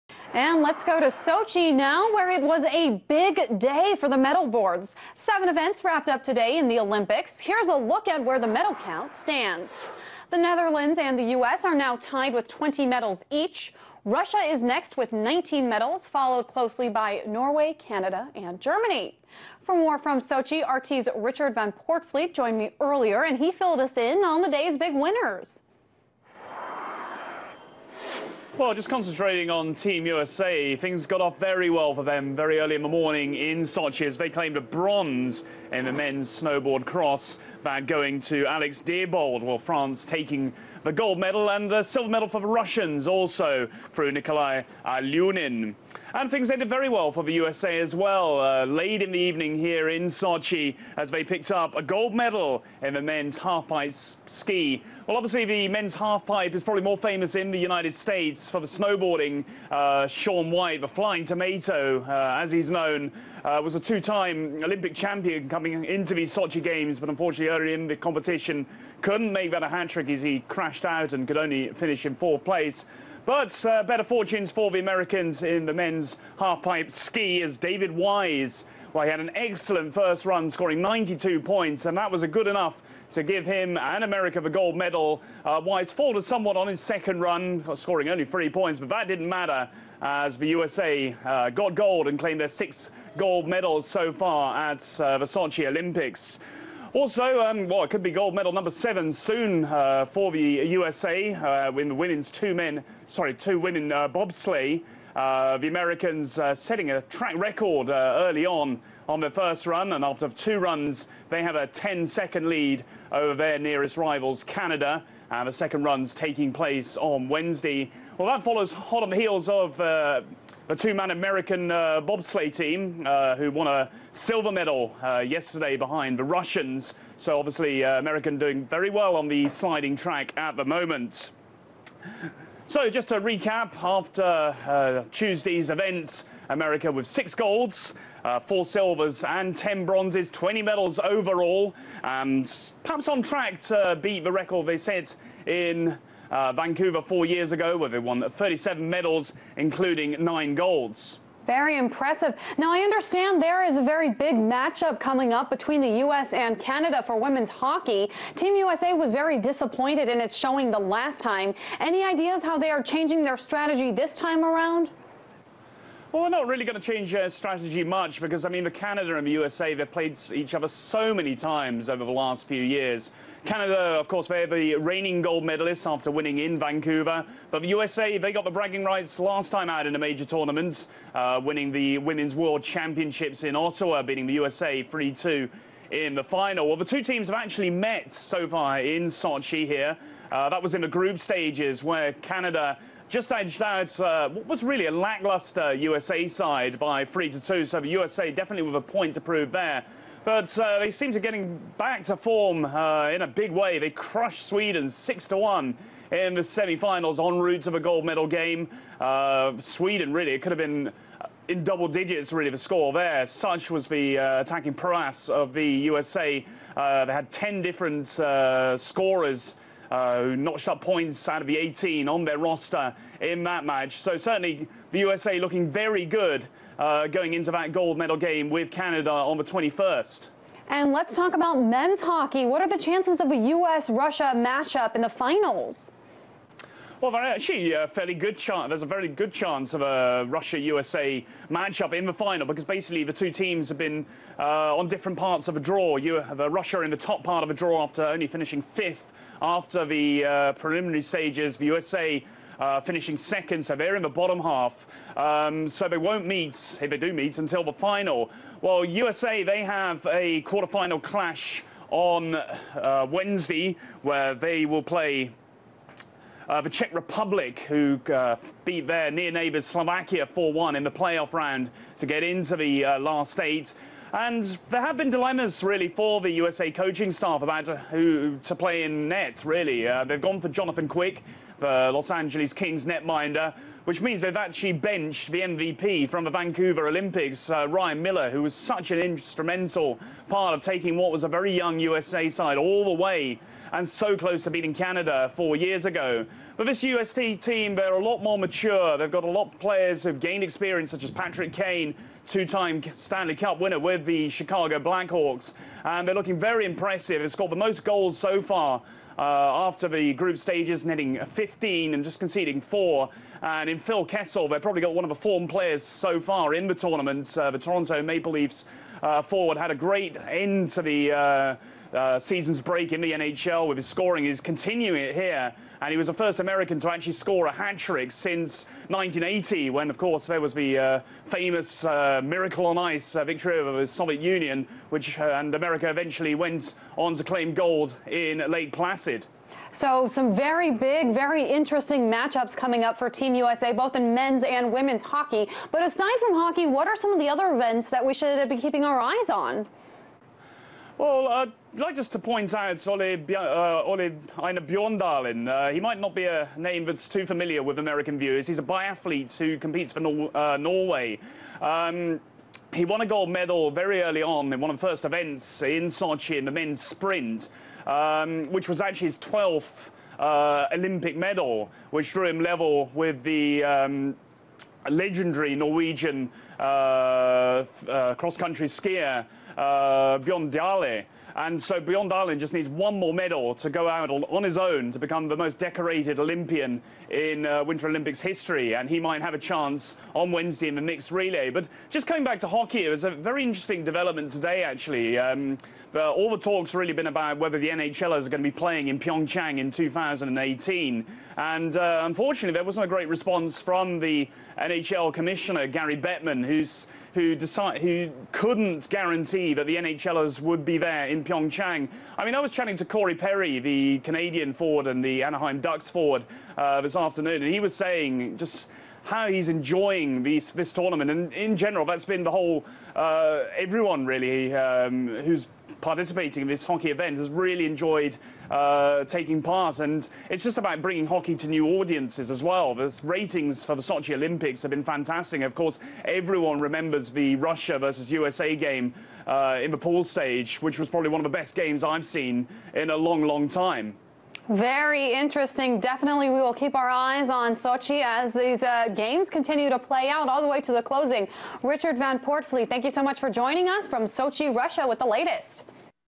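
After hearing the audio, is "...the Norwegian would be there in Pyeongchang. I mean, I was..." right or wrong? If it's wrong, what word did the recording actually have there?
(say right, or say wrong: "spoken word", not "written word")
wrong: "NHLers", not "Norwegian".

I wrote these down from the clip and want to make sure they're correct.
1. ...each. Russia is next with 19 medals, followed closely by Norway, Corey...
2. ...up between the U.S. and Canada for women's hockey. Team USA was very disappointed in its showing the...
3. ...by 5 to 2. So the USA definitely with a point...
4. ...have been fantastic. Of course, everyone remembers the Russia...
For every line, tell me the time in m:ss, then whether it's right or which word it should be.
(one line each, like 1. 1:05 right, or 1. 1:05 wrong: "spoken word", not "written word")
1. 0:13 wrong: "Canada", not "Corey"
2. 2:35 right
3. 3:16 wrong: "3", not "5"
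4. 7:14 right.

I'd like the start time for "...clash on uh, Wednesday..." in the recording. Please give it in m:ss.
4:21.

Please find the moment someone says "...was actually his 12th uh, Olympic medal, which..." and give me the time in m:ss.
6:08.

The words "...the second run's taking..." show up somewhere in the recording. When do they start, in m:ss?
1:55.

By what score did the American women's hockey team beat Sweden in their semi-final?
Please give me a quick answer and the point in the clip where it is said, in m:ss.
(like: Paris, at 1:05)
6 to 1, at 3:24.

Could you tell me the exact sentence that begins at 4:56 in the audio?
But this UST team, they're a lot more mature.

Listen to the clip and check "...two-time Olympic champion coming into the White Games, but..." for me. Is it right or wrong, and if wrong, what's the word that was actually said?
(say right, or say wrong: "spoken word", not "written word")
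wrong: "Sochi", not "White".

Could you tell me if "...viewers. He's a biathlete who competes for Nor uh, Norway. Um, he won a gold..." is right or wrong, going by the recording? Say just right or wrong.
right.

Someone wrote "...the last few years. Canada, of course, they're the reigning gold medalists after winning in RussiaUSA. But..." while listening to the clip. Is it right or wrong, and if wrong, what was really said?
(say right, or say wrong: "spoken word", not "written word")
wrong: "Vancouver", not "RussiaUSA".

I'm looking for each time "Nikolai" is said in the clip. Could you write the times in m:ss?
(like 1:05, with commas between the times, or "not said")
0:44.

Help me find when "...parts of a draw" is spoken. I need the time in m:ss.
4:05.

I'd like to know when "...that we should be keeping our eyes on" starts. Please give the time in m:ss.
5:47.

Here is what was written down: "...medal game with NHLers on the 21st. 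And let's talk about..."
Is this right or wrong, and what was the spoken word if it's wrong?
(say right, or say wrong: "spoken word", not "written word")
wrong: "Canada", not "NHLers".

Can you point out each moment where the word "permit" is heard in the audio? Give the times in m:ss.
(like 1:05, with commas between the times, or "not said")
not said.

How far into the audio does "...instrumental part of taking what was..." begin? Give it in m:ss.
4:48.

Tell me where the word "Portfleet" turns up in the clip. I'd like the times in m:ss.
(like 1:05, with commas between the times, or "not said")
0:21, 7:32.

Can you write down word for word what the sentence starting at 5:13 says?
And in Phil Kessel, they've probably got one of the form players so far in the tournament.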